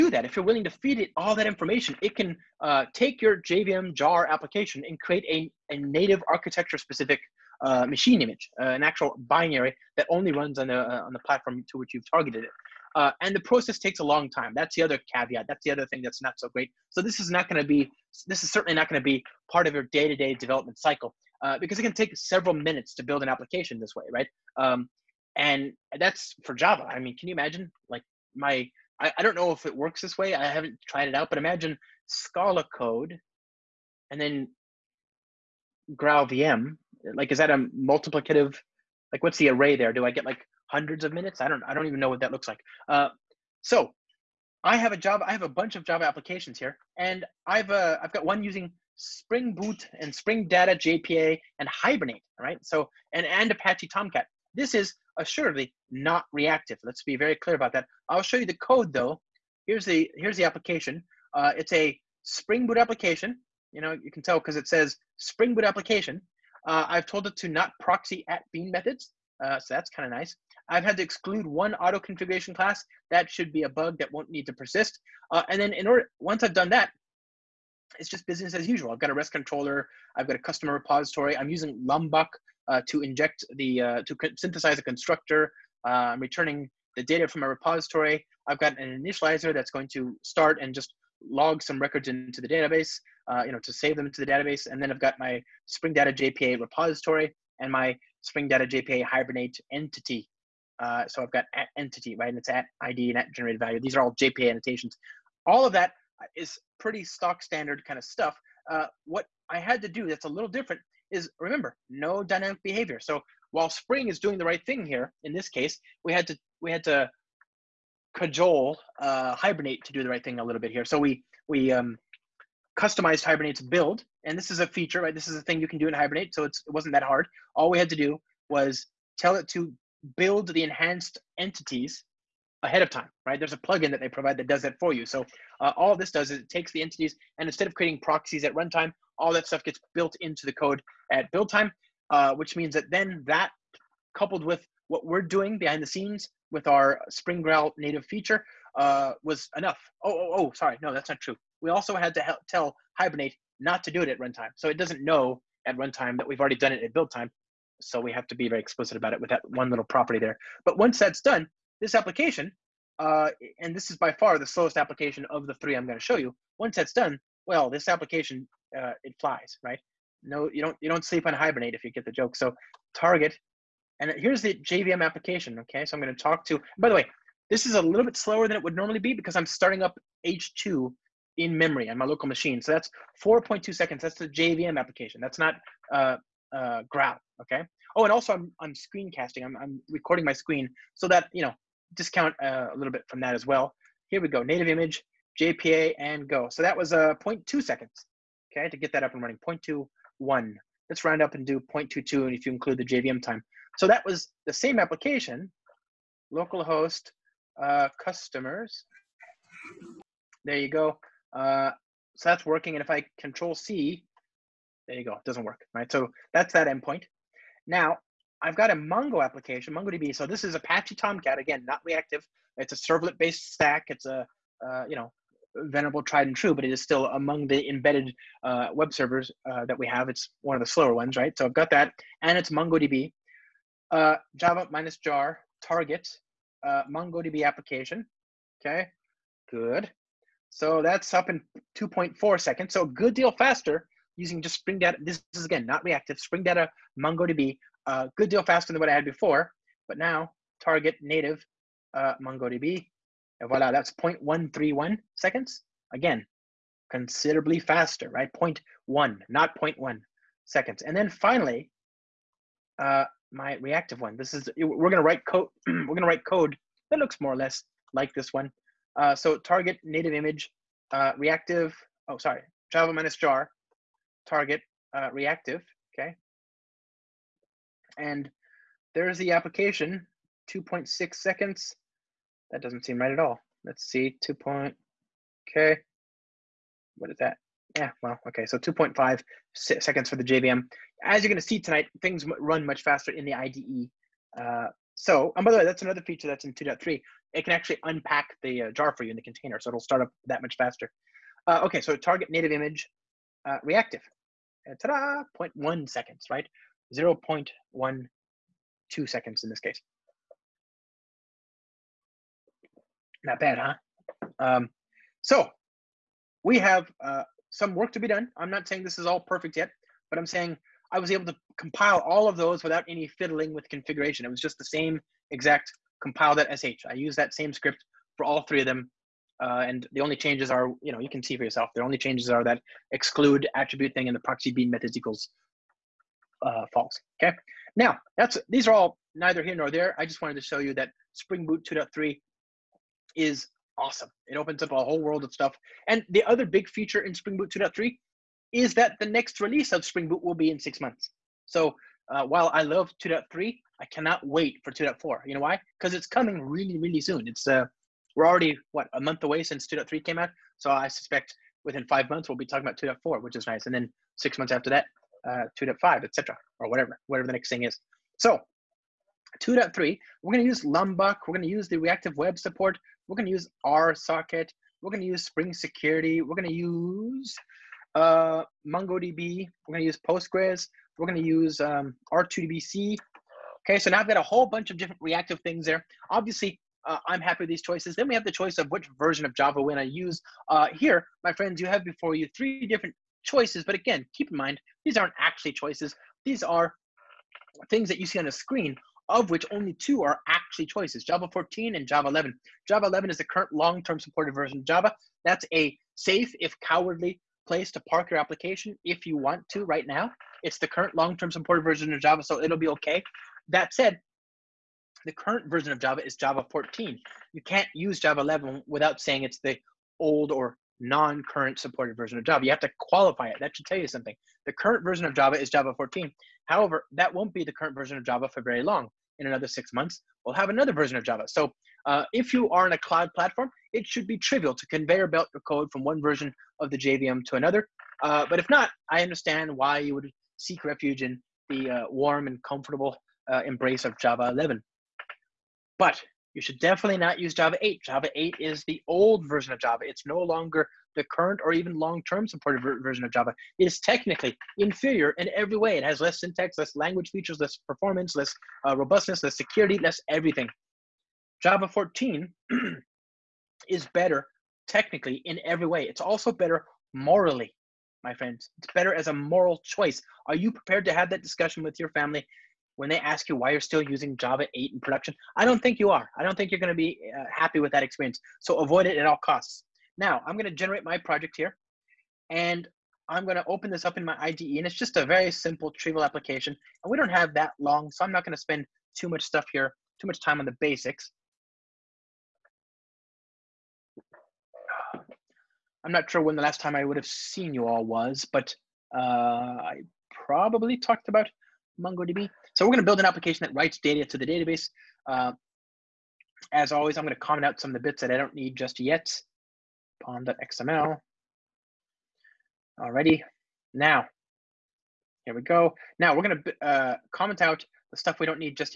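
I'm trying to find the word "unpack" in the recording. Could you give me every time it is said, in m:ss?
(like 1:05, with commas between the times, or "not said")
4:57.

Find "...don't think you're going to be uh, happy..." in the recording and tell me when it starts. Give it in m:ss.
7:56.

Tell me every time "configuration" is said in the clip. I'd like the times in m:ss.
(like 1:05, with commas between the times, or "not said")
1:11, 5:23.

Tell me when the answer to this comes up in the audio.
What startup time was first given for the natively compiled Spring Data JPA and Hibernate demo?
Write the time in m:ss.
3:17.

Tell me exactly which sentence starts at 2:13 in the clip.
There's a plugin that they provide that does that for you.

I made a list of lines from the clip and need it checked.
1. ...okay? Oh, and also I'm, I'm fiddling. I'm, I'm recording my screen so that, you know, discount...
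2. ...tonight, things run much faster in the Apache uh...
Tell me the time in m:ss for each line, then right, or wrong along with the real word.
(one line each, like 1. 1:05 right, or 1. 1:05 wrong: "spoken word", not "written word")
1. 3:07 wrong: "screencasting", not "fiddling"
2. 4:51 wrong: "IDE", not "Apache".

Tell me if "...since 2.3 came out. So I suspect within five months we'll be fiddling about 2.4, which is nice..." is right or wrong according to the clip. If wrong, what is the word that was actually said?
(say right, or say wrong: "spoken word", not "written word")
wrong: "talking", not "fiddling".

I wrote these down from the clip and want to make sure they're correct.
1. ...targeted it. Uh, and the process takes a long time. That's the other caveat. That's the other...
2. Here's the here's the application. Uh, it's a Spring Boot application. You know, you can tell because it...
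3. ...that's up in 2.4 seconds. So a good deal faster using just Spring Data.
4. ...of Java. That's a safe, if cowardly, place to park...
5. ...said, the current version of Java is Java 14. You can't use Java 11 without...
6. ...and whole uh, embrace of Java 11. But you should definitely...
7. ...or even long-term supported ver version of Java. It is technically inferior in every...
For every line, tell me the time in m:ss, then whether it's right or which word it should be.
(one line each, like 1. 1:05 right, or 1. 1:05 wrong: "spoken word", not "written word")
1. 0:12 right
2. 0:59 right
3. 4:00 right
4. 6:44 right
5. 6:53 right
6. 7:22 wrong: "comfortable", not "whole"
7. 7:31 right.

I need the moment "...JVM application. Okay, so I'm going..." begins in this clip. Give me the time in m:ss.
2:54.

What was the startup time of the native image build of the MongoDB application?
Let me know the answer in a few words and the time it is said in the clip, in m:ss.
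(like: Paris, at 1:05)
0.131 seconds, at 4:14.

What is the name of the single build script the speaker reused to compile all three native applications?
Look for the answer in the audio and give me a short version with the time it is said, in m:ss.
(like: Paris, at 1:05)
compile.sh, at 5:26.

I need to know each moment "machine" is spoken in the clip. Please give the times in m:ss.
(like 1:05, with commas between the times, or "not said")
0:07, 3:02.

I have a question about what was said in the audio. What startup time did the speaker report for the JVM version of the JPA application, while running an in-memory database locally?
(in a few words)
4.2 seconds.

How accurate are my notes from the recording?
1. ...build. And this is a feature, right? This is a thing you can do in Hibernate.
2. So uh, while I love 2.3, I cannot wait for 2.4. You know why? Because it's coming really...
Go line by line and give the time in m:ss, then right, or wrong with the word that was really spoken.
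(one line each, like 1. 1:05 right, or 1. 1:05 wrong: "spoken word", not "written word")
1. 2:03 right
2. 5:51 right.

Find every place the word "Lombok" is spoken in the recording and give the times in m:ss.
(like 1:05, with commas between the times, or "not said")
1:21, 6:10.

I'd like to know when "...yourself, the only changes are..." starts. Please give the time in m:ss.
5:31.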